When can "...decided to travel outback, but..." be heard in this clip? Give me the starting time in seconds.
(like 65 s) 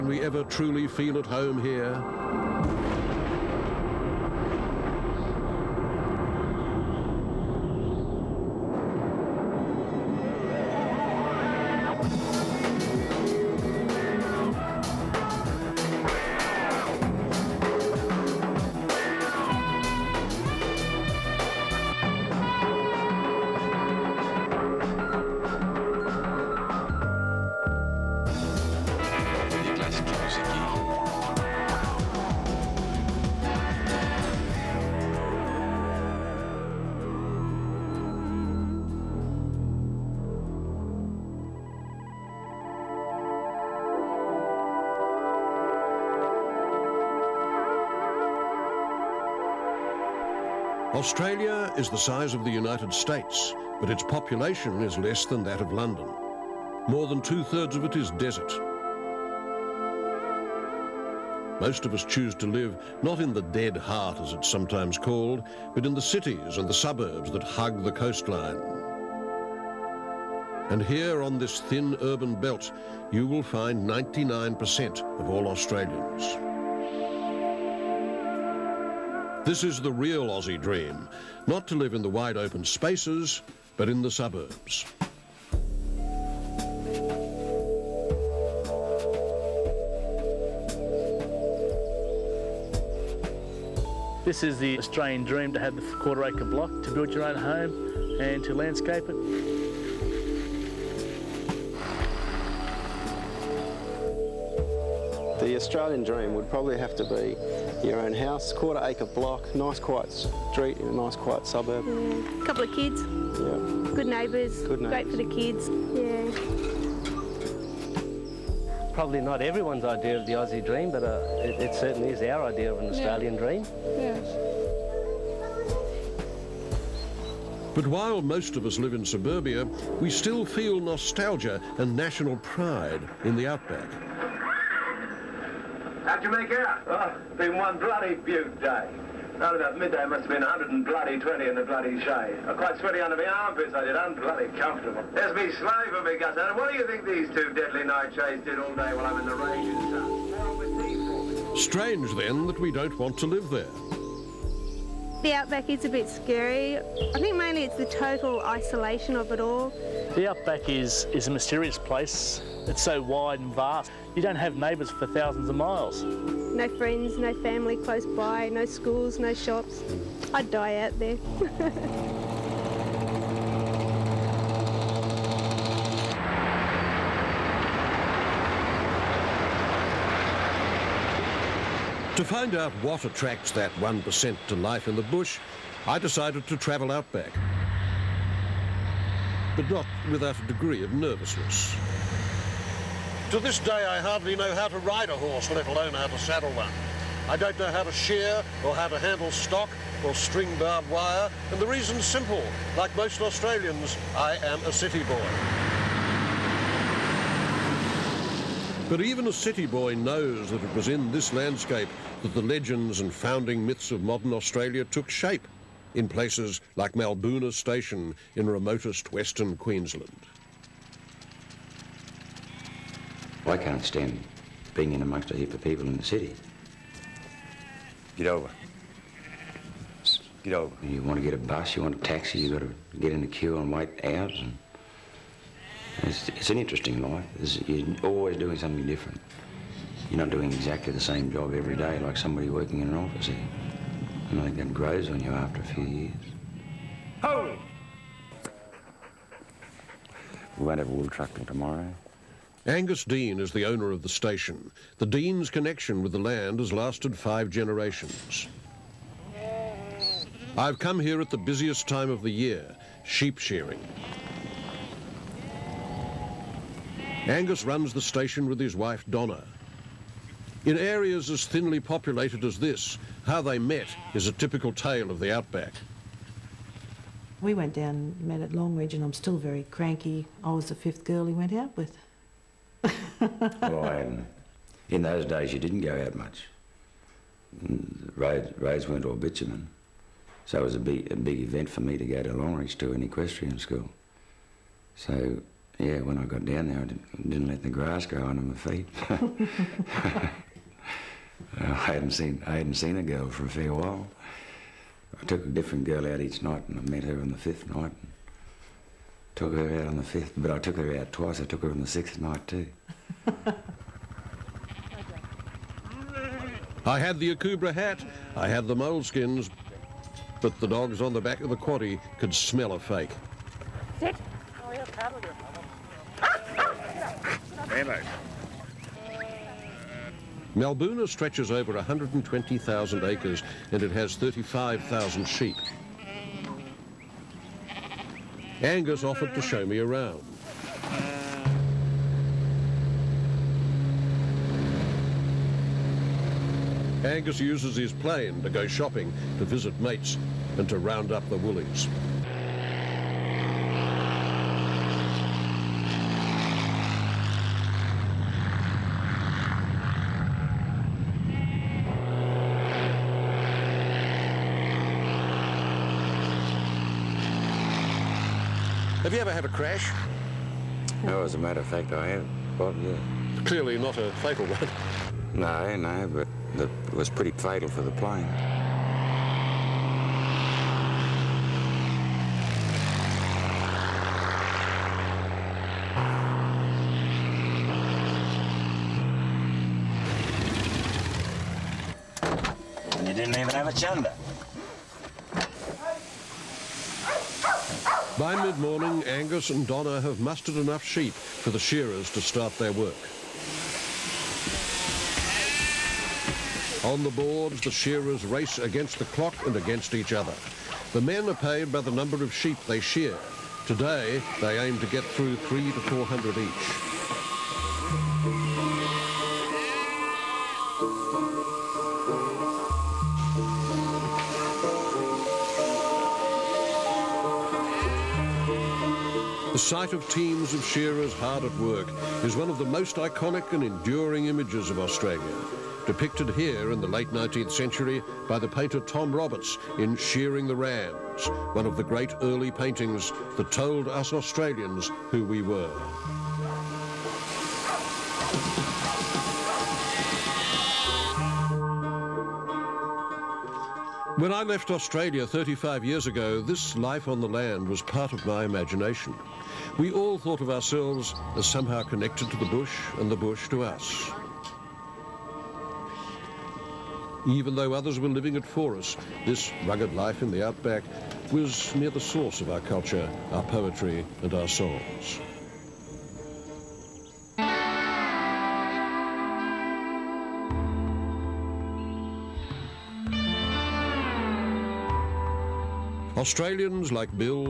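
185 s.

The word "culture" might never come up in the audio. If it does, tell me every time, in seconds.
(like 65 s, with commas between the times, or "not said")
472 s.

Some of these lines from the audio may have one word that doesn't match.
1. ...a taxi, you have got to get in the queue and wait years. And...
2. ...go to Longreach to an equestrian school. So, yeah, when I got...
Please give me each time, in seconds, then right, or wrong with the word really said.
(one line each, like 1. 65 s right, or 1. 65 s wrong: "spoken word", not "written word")
1. 231 s wrong: "hours", not "years"
2. 292 s right.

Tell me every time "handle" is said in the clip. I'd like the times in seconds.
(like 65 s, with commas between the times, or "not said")
198 s.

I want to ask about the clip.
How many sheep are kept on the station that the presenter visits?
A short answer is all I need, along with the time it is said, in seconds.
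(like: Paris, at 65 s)
35,000, at 334 s.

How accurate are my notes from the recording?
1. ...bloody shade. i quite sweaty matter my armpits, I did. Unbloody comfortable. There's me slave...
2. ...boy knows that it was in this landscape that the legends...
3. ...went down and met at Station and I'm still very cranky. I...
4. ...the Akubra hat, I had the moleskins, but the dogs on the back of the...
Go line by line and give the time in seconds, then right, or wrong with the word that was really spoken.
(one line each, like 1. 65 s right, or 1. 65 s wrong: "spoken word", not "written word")
1. 141 s wrong: "under", not "matter"
2. 209 s right
3. 277 s wrong: "Longreach", not "Station"
4. 317 s right.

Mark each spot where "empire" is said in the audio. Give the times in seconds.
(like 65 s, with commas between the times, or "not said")
not said.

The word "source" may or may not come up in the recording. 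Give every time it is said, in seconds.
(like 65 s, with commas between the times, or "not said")
471 s.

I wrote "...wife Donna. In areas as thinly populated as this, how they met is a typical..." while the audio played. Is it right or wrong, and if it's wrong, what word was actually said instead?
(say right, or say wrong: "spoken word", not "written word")
right.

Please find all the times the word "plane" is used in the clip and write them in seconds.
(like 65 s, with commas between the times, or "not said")
347 s, 377 s.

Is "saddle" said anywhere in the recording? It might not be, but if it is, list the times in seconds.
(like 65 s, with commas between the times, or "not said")
196 s.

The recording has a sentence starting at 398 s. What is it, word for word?
By mid-morning, Angus and Donna have mustered enough sheep for the shearers to start their work.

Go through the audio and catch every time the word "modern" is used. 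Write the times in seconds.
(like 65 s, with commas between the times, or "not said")
214 s.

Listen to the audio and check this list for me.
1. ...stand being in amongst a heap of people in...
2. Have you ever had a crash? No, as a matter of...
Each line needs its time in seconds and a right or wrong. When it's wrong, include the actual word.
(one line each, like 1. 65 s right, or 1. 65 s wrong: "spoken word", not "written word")
1. 223 s right
2. 369 s right.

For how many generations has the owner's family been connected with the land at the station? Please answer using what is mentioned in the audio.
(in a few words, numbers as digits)
5.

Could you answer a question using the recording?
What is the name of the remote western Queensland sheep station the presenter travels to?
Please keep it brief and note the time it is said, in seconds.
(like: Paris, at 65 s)
Malbuna Station, at 216 s.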